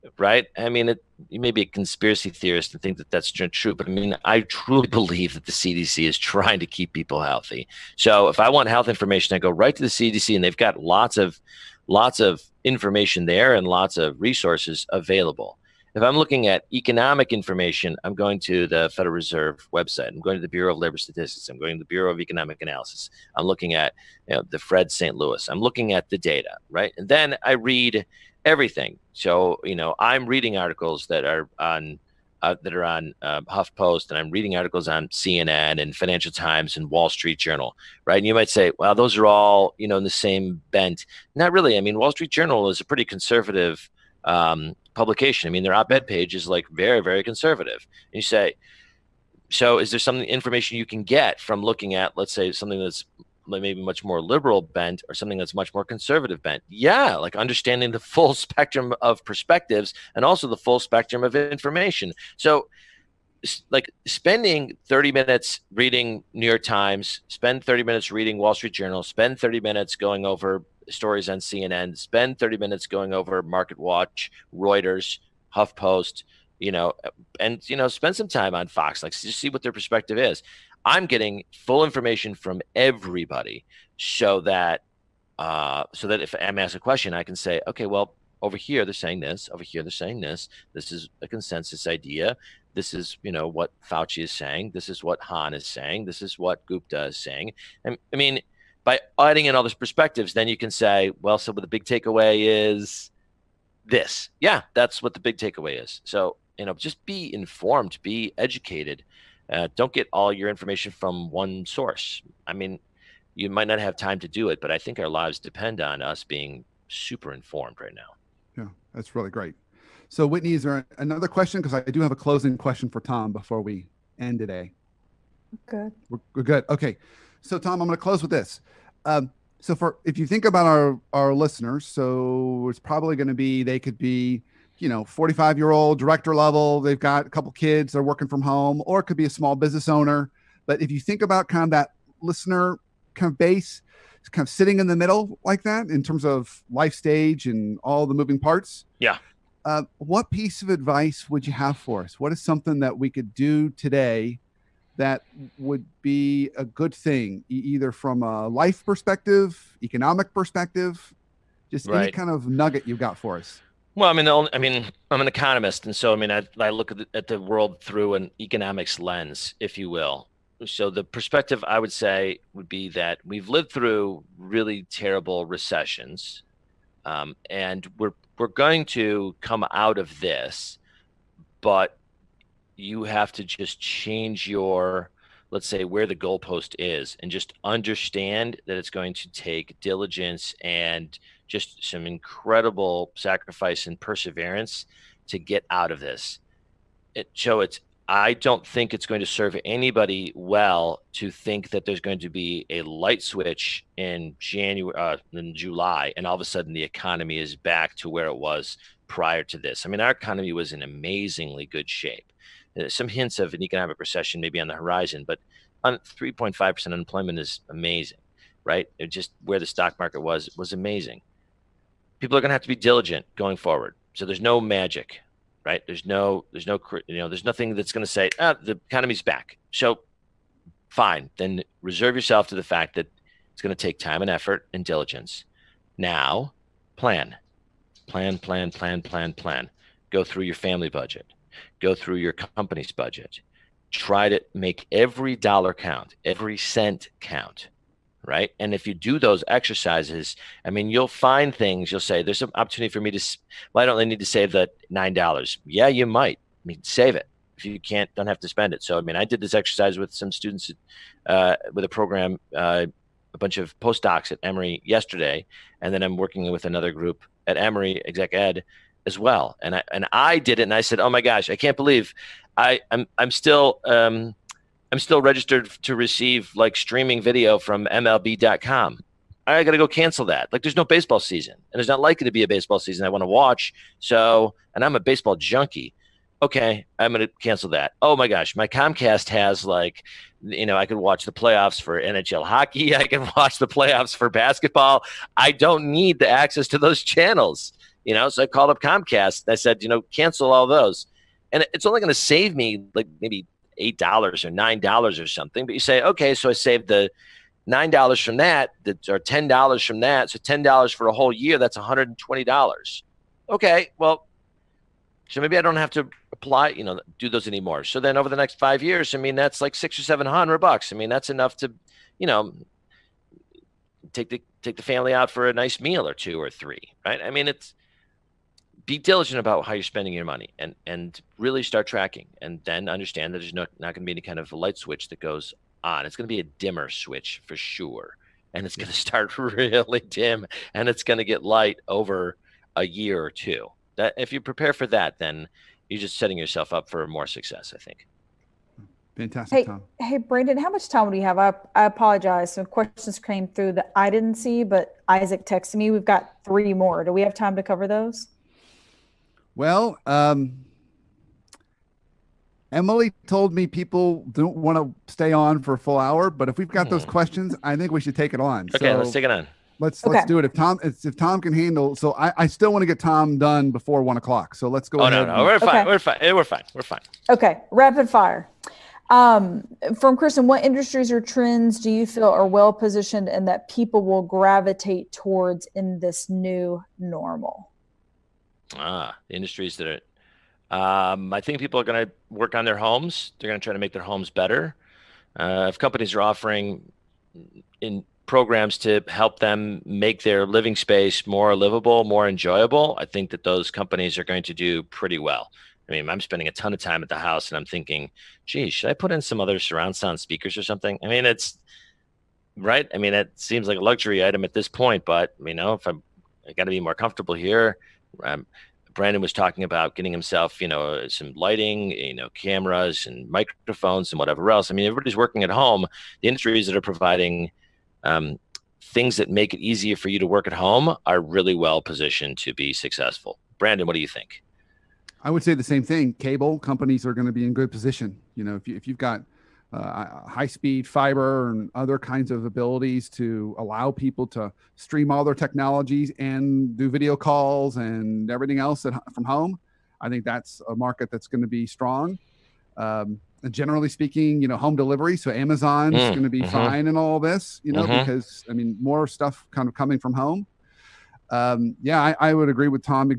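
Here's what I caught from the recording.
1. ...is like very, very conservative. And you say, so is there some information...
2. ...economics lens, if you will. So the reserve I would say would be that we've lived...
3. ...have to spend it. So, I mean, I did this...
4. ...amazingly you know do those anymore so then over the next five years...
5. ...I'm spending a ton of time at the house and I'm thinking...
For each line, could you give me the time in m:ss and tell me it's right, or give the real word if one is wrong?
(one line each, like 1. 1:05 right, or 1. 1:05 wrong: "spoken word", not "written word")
1. 0:46 right
2. 2:48 wrong: "perspective", not "reserve"
3. 4:18 right
4. 5:16 wrong: "apply", not "amazingly"
5. 6:46 right.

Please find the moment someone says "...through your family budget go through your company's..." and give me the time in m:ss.
4:00.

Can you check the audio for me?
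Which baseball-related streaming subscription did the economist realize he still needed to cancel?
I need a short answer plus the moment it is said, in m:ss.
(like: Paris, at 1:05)
MLB.com, at 4:37.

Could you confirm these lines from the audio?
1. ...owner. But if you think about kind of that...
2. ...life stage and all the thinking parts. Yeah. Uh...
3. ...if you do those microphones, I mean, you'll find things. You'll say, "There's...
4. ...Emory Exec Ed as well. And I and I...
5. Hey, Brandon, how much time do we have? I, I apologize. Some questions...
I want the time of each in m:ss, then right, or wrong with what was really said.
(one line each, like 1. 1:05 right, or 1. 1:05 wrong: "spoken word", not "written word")
1. 2:19 right
2. 2:26 wrong: "moving", not "thinking"
3. 4:08 wrong: "exercises", not "microphones"
4. 4:27 right
5. 5:49 right.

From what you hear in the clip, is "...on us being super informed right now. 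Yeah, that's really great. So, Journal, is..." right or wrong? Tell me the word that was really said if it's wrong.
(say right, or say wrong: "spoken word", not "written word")
wrong: "Whitney", not "Journal".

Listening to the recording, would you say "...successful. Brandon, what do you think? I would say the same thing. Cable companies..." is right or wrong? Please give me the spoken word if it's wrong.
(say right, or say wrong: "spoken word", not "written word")
right.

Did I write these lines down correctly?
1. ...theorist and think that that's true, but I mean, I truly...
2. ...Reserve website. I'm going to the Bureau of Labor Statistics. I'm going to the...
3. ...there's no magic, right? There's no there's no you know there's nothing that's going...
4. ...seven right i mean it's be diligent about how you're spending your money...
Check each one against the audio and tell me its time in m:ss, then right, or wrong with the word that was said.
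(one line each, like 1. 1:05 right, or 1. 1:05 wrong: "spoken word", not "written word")
1. 0:02 right
2. 0:19 right
3. 3:44 right
4. 5:26 wrong: "three", not "seven".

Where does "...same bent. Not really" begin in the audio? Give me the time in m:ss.
0:40.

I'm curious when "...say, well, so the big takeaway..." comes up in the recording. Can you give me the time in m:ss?
1:40.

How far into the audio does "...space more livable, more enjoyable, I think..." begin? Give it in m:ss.
6:40.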